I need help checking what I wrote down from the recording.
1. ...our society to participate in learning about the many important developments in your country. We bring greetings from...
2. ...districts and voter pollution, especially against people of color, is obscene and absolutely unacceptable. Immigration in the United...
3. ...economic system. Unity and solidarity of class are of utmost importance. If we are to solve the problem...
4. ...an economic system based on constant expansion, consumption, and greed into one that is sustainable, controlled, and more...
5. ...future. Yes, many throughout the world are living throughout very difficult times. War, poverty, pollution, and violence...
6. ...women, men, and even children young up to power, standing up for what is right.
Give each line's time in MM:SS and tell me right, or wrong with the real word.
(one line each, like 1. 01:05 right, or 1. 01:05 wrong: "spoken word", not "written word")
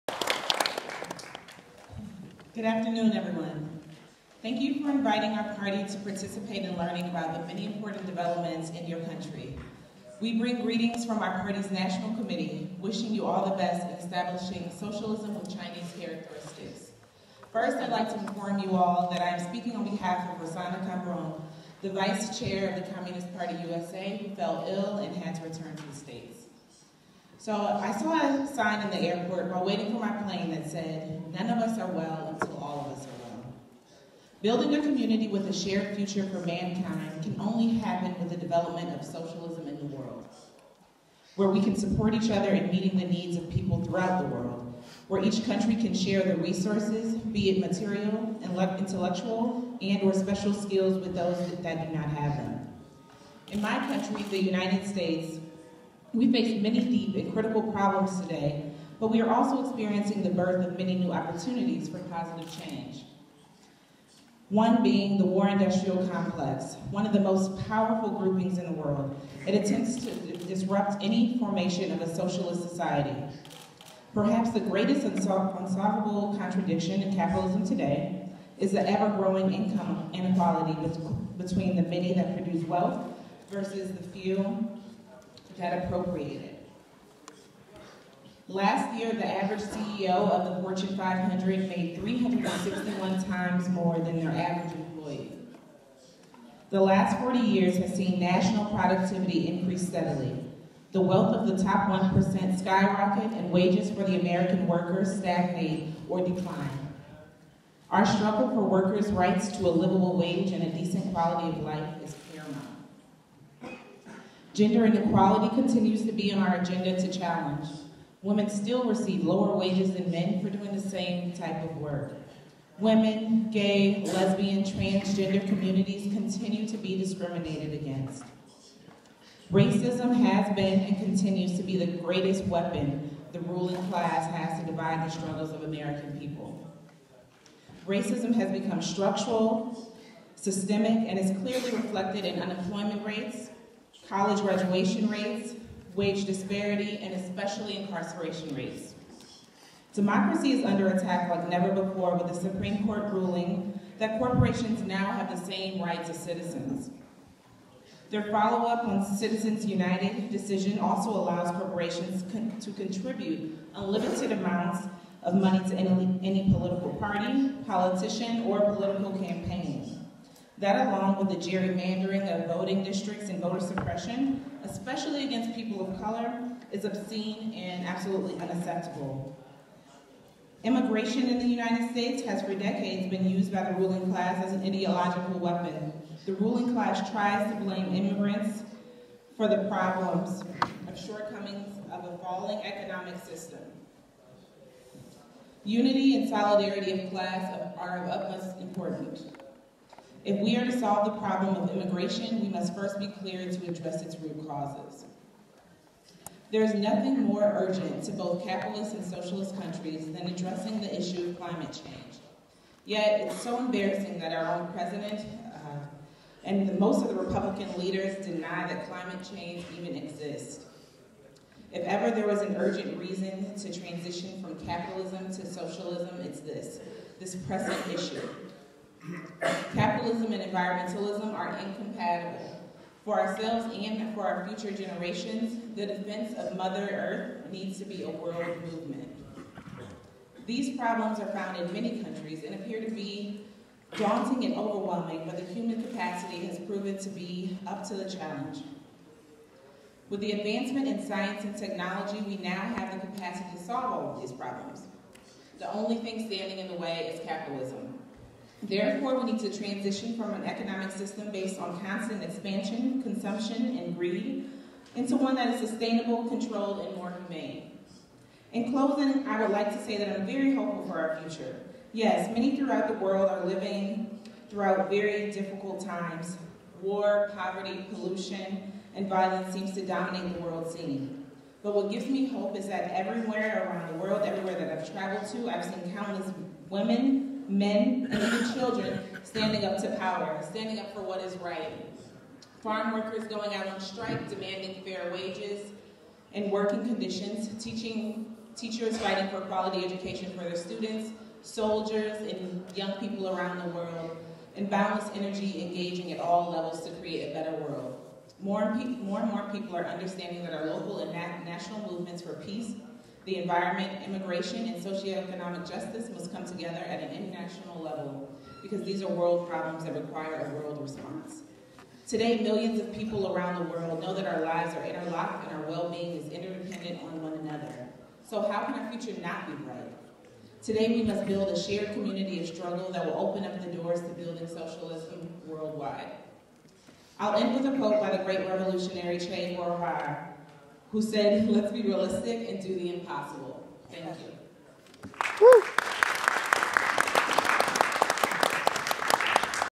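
1. 00:05 wrong: "party", not "society"
2. 02:52 wrong: "suppression", not "pollution"
3. 03:12 right
4. 04:20 right
5. 04:31 right
6. 04:46 wrong: "standing", not "young".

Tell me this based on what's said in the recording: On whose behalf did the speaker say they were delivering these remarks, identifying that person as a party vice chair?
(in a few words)
Rossana Cambron.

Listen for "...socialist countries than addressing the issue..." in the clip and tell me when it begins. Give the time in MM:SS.
03:29.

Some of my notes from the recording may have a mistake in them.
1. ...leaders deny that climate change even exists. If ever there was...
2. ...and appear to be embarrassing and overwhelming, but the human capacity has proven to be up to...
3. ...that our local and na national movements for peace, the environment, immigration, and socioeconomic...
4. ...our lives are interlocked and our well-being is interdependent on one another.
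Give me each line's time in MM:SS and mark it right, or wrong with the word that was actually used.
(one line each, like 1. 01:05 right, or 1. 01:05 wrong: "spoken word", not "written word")
1. 03:37 right
2. 04:02 wrong: "daunting", not "embarrassing"
3. 05:10 right
4. 05:24 right.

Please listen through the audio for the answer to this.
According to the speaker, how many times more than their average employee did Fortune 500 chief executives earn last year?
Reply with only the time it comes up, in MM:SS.
01:31.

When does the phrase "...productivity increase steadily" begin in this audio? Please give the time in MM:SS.
01:38.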